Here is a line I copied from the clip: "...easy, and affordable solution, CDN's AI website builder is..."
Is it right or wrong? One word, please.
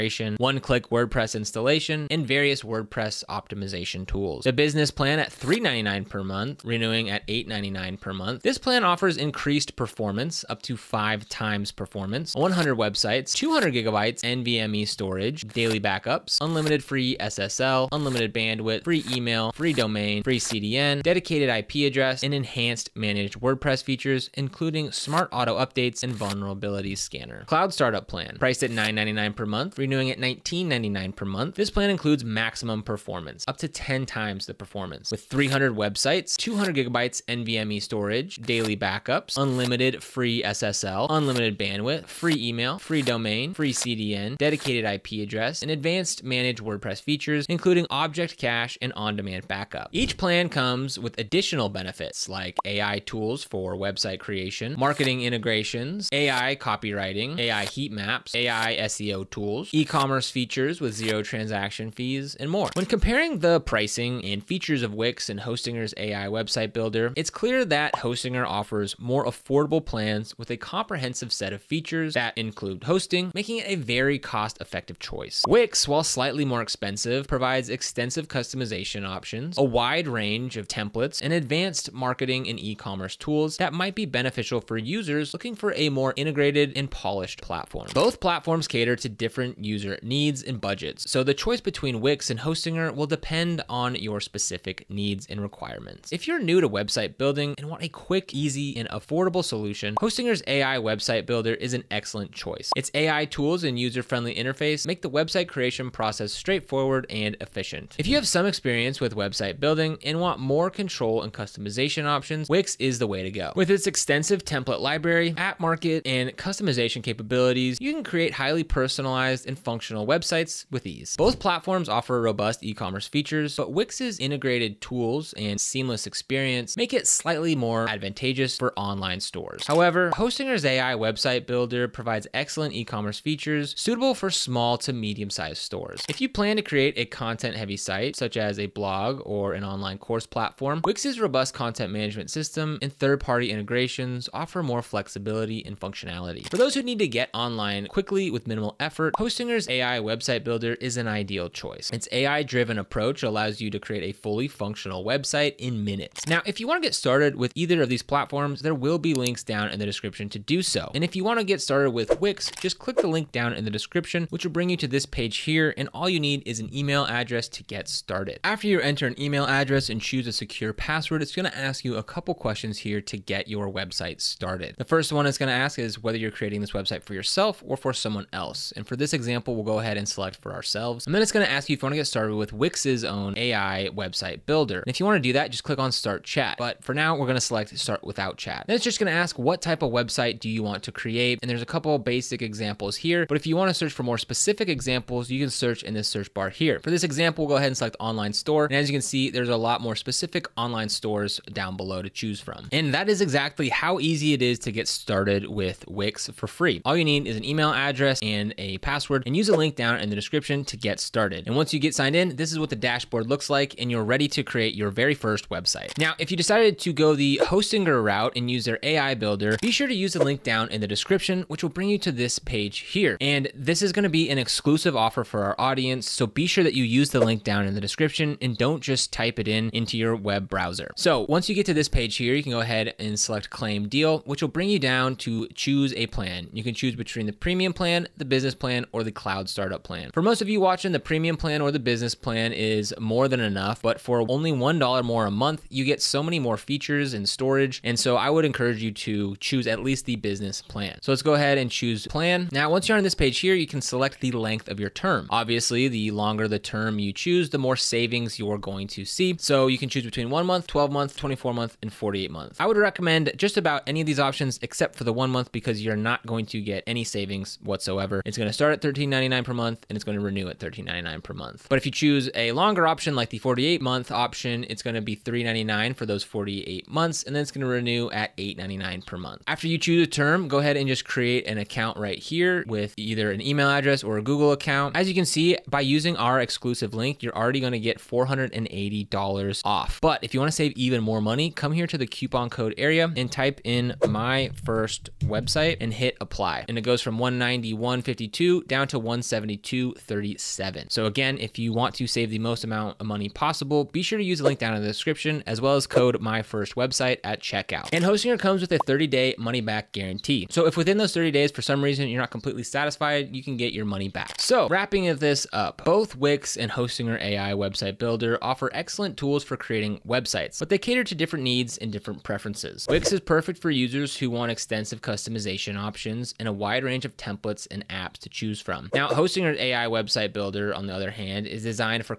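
wrong.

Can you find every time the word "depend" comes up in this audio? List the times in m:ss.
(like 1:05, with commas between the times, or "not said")
1:33.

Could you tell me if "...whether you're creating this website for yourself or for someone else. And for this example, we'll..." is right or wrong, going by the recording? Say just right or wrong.
right.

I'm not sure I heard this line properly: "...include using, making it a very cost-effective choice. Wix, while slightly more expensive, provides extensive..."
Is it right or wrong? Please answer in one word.
wrong.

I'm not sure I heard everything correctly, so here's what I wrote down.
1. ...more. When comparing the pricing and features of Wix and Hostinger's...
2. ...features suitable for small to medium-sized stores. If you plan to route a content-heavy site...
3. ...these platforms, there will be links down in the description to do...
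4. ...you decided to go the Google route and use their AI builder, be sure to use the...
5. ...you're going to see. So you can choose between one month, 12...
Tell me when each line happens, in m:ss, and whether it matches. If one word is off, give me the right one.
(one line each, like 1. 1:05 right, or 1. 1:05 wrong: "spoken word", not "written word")
1. 1:02 right
2. 2:13 wrong: "create", not "route"
3. 2:37 right
4. 3:36 wrong: "Hostinger", not "Google"
5. 4:18 right.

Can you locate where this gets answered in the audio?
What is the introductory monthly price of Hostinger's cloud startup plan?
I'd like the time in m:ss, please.
0:28.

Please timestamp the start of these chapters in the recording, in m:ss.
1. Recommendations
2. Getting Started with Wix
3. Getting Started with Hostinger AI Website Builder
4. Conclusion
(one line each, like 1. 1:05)
1. 1:35
2. 2:42
3. 3:35
4. 5:14.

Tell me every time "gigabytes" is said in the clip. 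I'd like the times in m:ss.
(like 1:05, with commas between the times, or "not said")
0:13, 0:36.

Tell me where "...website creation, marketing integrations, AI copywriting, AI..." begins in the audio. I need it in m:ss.
0:53.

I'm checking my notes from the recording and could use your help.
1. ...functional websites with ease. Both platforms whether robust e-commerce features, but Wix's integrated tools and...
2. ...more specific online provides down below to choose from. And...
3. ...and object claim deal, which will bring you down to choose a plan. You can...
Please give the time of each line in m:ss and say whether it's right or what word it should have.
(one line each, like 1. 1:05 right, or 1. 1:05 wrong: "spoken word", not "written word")
1. 1:59 wrong: "offer", not "whether"
2. 3:19 wrong: "stores", not "provides"
3. 3:53 wrong: "select", not "object".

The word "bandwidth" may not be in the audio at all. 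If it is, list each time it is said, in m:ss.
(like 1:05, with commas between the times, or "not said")
0:18, 0:41.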